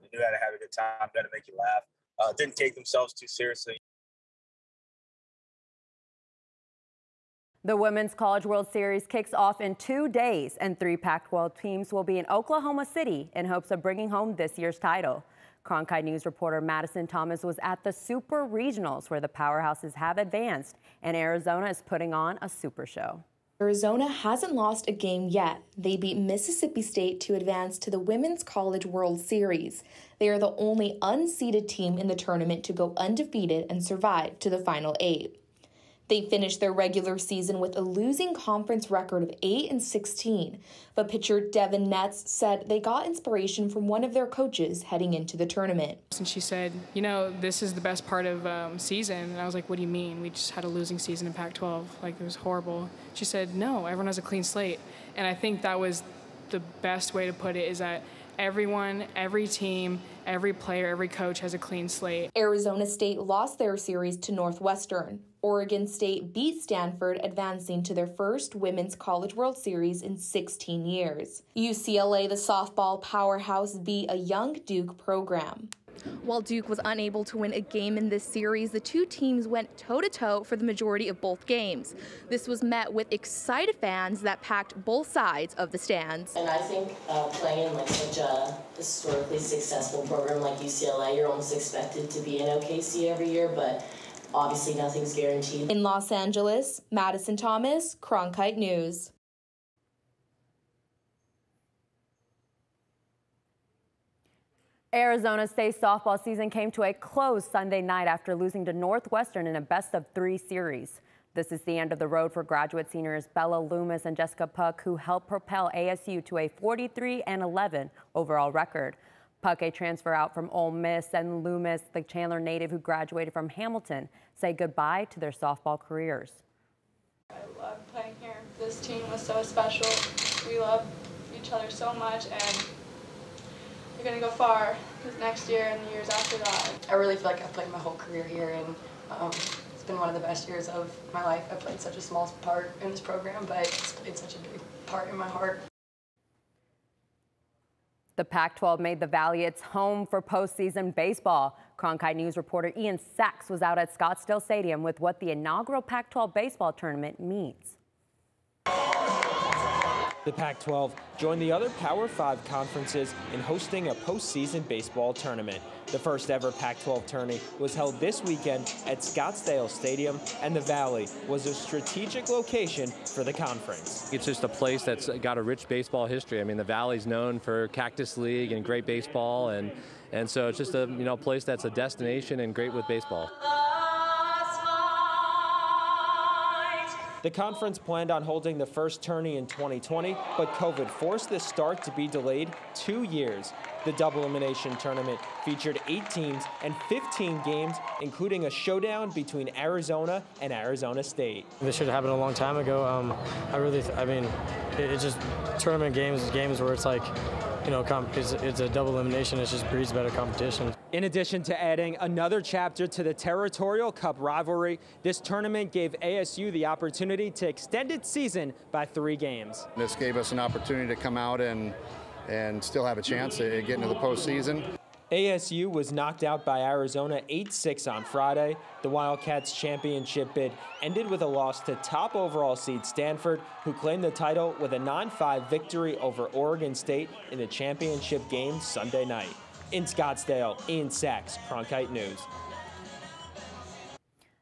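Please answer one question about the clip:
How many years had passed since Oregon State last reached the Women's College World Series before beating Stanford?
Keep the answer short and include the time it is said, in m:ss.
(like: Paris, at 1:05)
16 years, at 1:10.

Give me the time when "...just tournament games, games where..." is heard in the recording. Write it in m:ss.
3:25.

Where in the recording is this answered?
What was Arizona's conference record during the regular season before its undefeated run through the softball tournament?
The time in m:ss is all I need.
0:39.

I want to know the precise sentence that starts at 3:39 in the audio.
This gave us an opportunity to come out and, and still have a chance to get into the postseason.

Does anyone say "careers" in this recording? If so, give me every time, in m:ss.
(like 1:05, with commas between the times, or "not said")
2:05, 2:17.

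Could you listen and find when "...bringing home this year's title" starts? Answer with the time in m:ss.
0:13.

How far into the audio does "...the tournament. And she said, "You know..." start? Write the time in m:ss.
0:45.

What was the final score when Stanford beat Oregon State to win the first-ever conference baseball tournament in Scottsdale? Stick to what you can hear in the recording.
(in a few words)
9-5.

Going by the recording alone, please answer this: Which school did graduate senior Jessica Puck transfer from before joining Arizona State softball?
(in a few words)
Ole Miss.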